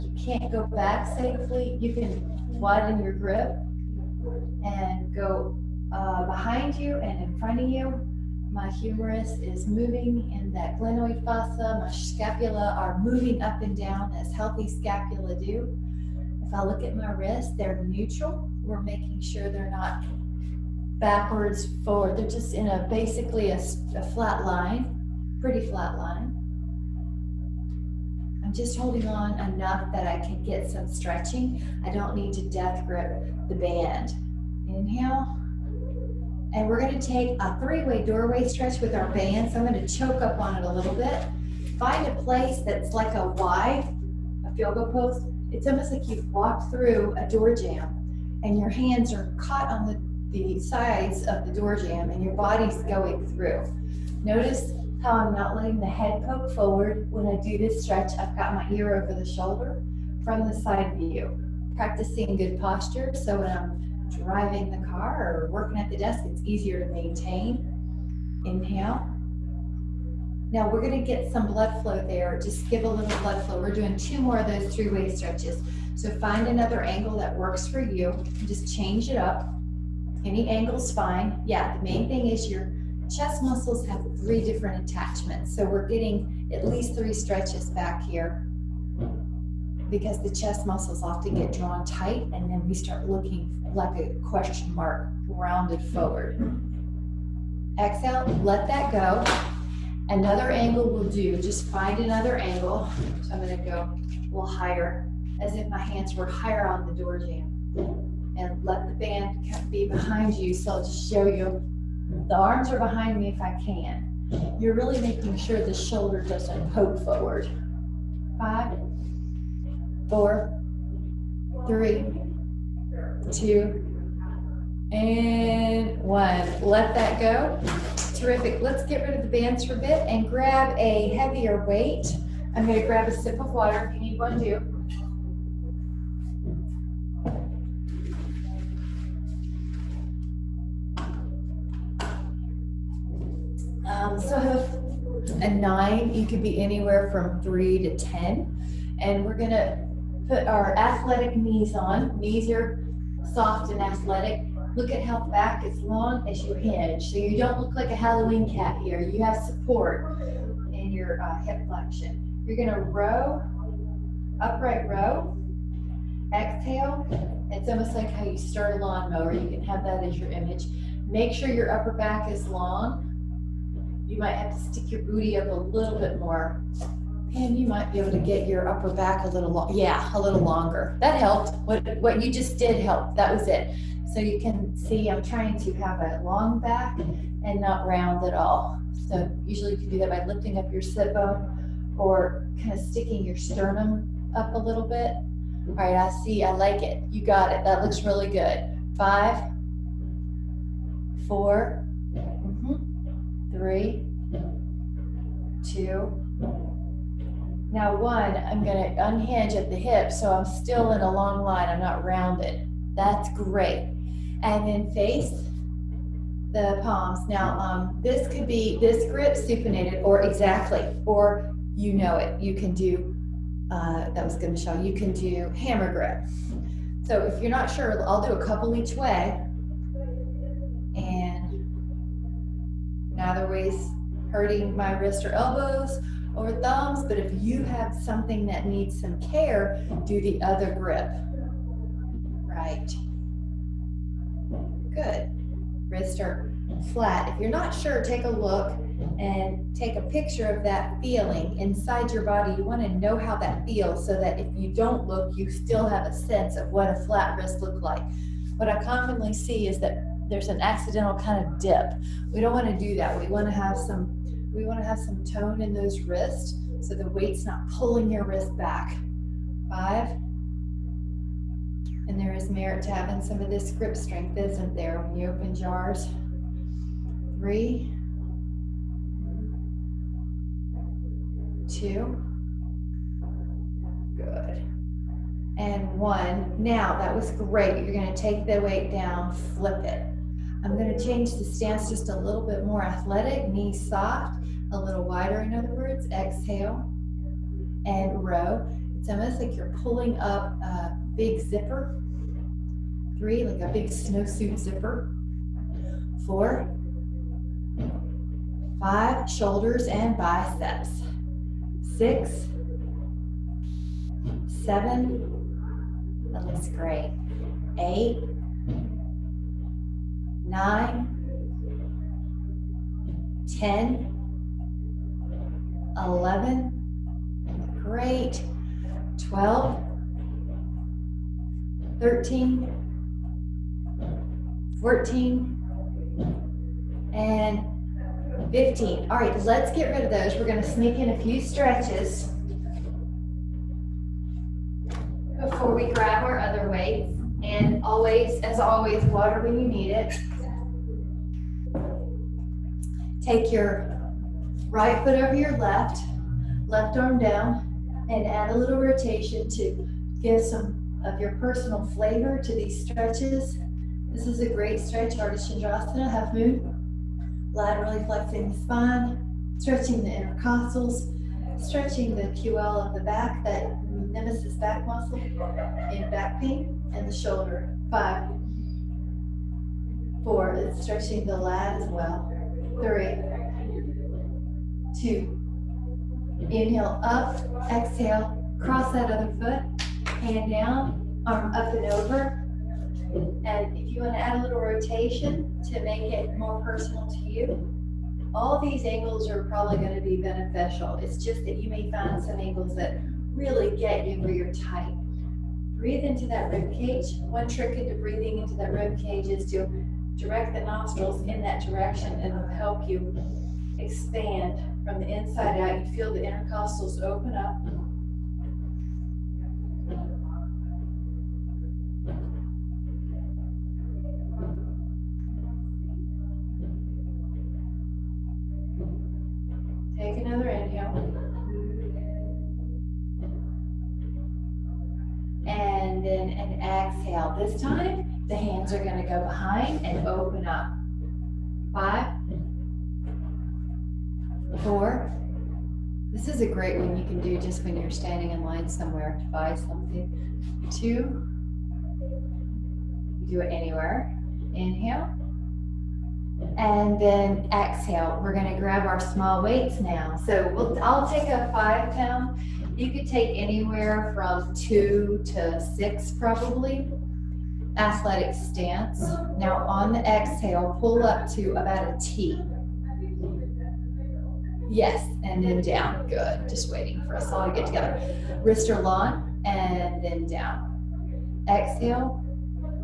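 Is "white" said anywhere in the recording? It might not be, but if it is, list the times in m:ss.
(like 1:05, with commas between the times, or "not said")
not said.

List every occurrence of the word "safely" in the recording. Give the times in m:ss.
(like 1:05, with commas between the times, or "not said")
0:01.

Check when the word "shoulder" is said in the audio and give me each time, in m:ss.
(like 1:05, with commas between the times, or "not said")
0:59, 1:55, 5:09, 6:17.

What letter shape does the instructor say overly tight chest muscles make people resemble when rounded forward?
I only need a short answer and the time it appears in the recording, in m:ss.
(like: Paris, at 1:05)
question mark, at 1:33.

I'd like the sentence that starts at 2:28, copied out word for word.
And we're going to put our athletic knees on.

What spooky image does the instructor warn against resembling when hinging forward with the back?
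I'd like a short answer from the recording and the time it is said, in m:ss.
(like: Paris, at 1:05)
Halloween cat, at 2:37.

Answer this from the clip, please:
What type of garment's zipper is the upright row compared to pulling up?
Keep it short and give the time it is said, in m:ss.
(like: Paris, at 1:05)
snowsuit, at 5:03.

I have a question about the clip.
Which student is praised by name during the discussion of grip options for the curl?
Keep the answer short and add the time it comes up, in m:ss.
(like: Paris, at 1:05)
Michelle, at 3:44.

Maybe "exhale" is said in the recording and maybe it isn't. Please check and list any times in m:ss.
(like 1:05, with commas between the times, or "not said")
1:37, 2:46, 4:56, 6:27, 7:16, 7:37, 7:50, 8:01.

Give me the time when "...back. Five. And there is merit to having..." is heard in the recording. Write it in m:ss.
4:28.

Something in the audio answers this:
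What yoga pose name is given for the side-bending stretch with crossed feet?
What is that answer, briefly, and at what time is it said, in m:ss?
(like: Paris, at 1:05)
Ardha Chandrasana, at 6:05.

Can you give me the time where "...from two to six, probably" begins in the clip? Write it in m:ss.
7:44.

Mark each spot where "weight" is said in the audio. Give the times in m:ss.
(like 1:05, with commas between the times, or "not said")
2:11, 4:27, 4:48, 5:46, 7:39.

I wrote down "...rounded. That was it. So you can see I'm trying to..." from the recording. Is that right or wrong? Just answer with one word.
wrong.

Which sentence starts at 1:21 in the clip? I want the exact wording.
Yeah, the main thing is your chest muscles have three different attachments.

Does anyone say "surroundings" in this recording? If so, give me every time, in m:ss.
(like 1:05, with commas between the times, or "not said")
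not said.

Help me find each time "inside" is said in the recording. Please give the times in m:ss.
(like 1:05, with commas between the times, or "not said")
4:11, 6:55.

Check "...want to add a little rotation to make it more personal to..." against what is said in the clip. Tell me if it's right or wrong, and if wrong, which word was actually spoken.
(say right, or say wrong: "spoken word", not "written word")
right.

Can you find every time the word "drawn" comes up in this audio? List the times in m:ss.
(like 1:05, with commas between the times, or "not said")
1:31.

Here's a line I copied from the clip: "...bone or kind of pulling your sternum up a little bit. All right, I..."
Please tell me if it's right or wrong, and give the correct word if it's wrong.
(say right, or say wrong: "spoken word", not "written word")
wrong: "sticking", not "pulling".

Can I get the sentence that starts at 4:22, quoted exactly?
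We don't want to do that.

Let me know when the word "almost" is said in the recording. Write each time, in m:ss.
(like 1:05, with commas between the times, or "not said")
0:45, 2:47, 4:59.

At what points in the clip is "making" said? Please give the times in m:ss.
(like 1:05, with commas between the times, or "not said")
0:18, 1:54.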